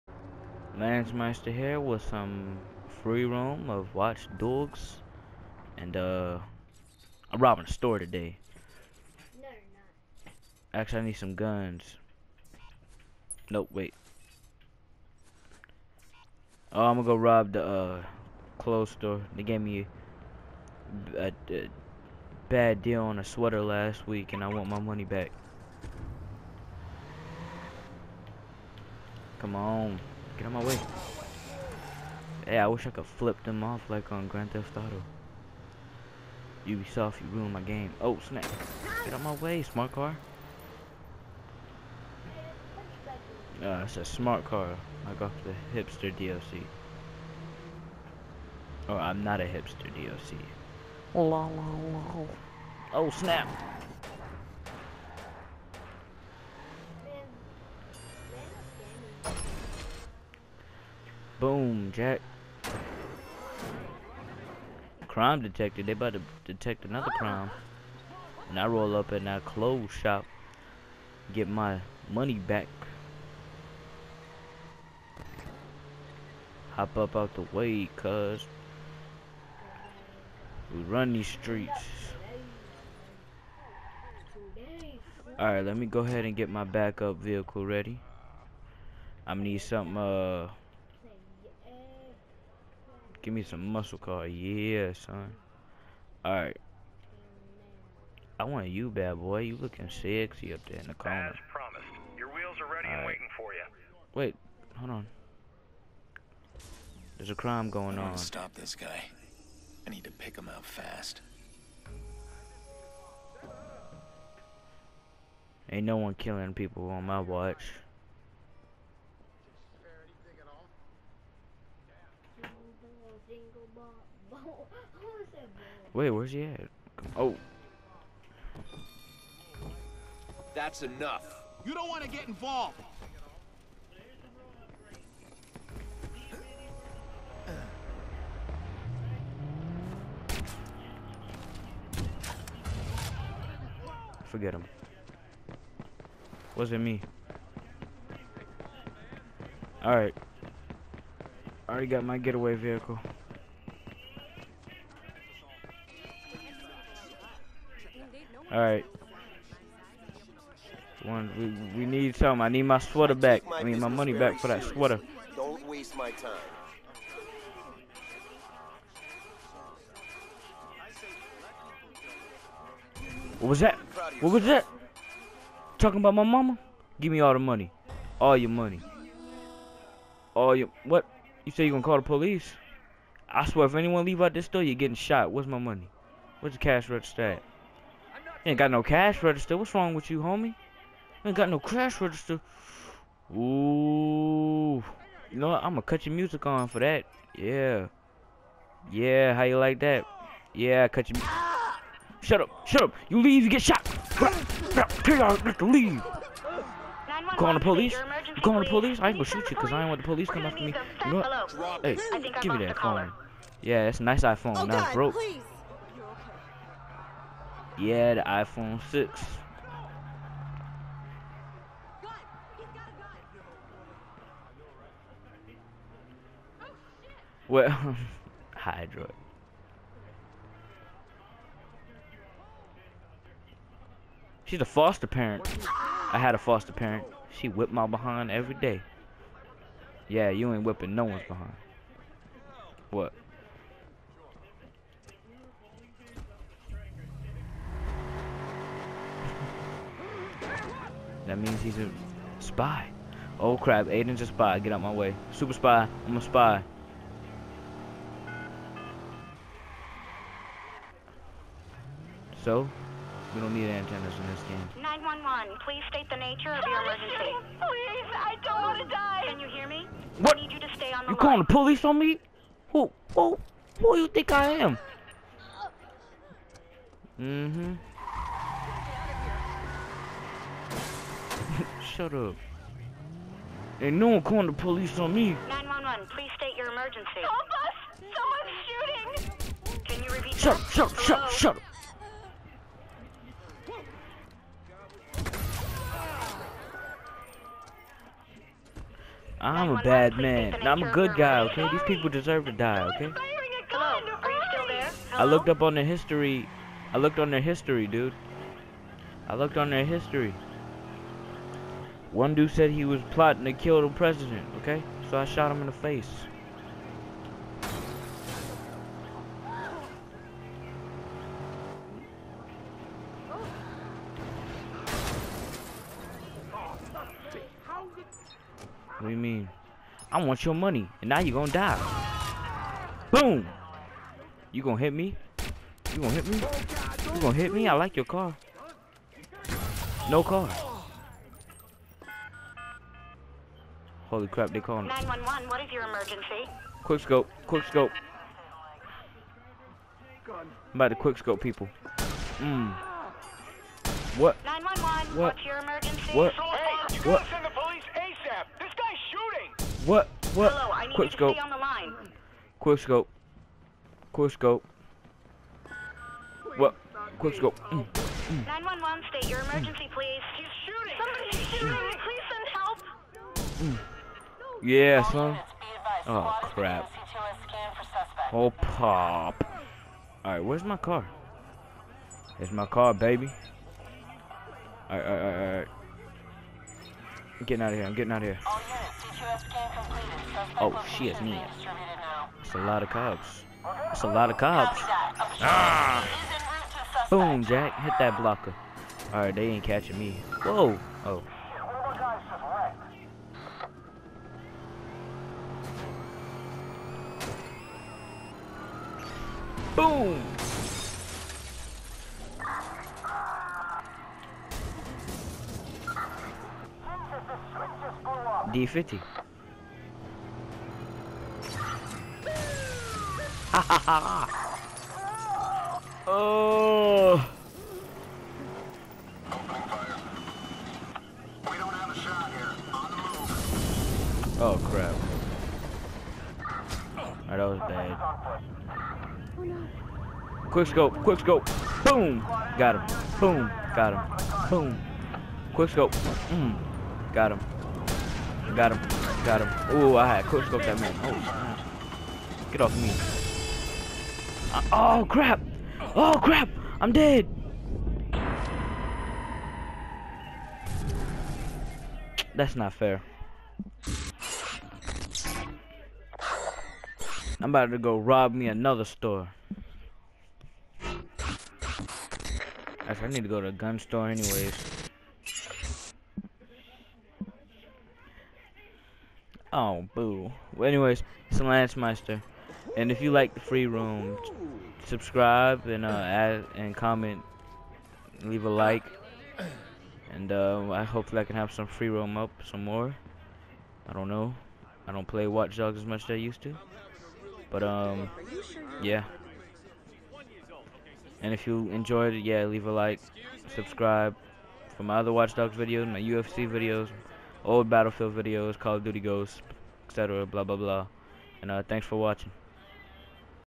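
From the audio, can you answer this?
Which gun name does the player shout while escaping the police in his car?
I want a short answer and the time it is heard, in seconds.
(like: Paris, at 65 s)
D50, at 418 s.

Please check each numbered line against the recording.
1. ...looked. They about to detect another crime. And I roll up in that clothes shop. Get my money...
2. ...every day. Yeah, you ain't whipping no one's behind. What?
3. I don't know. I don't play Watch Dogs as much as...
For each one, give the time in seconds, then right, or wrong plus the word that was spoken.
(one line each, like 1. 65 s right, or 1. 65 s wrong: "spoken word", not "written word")
1. 65 s wrong: "detected", not "looked"
2. 238 s right
3. 493 s right.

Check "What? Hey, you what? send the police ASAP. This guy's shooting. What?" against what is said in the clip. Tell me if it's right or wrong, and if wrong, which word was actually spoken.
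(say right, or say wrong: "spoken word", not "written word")
right.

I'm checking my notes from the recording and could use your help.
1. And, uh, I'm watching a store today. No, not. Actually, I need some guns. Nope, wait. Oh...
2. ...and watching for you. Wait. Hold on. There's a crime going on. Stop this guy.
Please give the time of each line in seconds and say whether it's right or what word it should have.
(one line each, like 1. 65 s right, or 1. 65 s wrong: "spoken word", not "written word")
1. 5 s wrong: "robbing", not "watching"
2. 102 s wrong: "waiting", not "watching".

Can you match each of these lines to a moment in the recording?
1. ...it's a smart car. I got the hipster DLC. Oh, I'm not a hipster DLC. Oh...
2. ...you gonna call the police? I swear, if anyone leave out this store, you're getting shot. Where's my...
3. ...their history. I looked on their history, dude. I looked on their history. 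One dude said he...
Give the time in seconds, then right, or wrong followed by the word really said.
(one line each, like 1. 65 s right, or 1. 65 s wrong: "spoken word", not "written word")
1. 43 s right
2. 181 s right
3. 305 s right.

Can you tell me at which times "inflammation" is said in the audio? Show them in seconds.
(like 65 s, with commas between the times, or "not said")
not said.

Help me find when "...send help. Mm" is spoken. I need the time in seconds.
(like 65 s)
372 s.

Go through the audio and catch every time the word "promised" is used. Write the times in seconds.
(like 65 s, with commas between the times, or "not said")
101 s.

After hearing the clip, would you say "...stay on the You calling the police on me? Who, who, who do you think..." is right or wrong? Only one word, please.
right.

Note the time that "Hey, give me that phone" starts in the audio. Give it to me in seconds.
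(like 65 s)
211 s.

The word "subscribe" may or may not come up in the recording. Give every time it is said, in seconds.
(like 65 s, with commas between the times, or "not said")
484 s, 503 s.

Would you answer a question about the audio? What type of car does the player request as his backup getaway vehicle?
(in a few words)
Muscle car.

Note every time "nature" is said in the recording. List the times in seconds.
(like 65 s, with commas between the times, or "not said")
266 s.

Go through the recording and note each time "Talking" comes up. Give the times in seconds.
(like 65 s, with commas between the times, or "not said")
175 s.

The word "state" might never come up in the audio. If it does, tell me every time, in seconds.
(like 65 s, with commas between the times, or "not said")
265 s, 286 s, 369 s.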